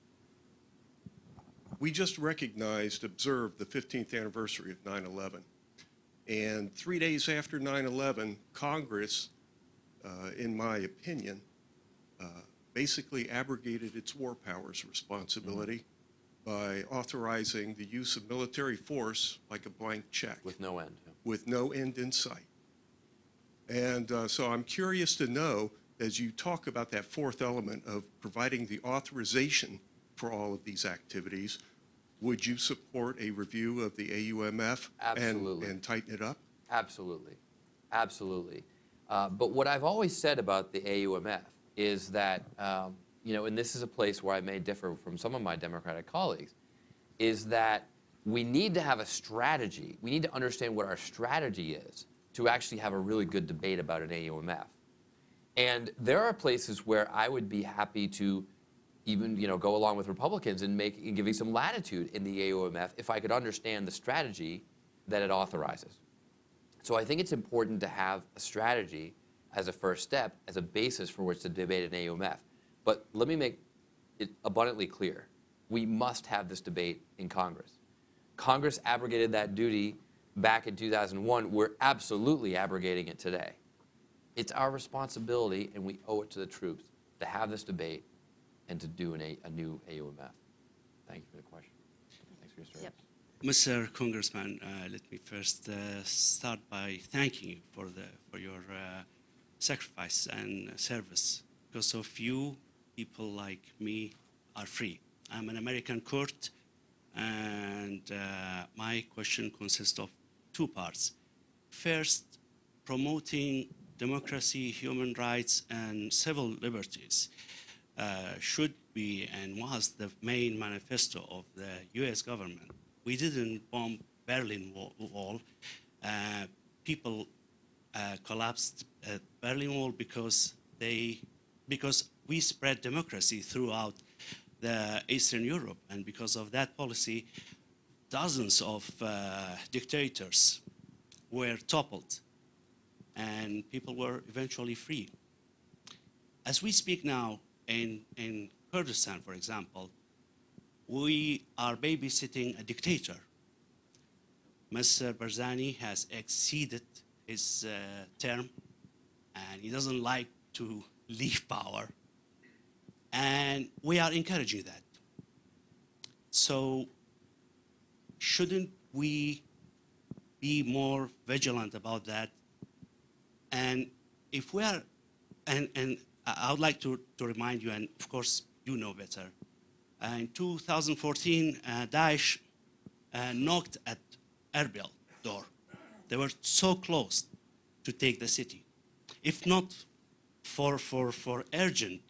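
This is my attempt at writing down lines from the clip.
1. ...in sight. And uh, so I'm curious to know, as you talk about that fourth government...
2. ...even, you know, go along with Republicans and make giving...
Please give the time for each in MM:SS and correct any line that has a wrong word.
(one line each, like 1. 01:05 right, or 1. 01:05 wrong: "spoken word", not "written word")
1. 00:21 wrong: "element", not "government"
2. 00:59 right.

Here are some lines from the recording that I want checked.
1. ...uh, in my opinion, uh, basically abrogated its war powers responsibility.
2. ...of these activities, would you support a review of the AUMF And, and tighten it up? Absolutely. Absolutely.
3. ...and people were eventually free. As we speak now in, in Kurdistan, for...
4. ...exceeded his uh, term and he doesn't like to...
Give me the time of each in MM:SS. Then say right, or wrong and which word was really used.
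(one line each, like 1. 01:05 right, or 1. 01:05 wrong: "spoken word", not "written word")
1. 00:10 right
2. 00:30 right
3. 02:23 right
4. 02:36 right.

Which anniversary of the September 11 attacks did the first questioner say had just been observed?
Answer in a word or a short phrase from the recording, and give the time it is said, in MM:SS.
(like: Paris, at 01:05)
15th, at 00:03.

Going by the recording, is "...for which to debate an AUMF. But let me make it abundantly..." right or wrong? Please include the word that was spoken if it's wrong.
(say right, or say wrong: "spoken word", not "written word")
right.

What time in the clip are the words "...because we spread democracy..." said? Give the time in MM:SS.
02:11.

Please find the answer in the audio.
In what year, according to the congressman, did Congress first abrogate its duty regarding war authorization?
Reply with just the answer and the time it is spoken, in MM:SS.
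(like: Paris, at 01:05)
2001, at 01:20.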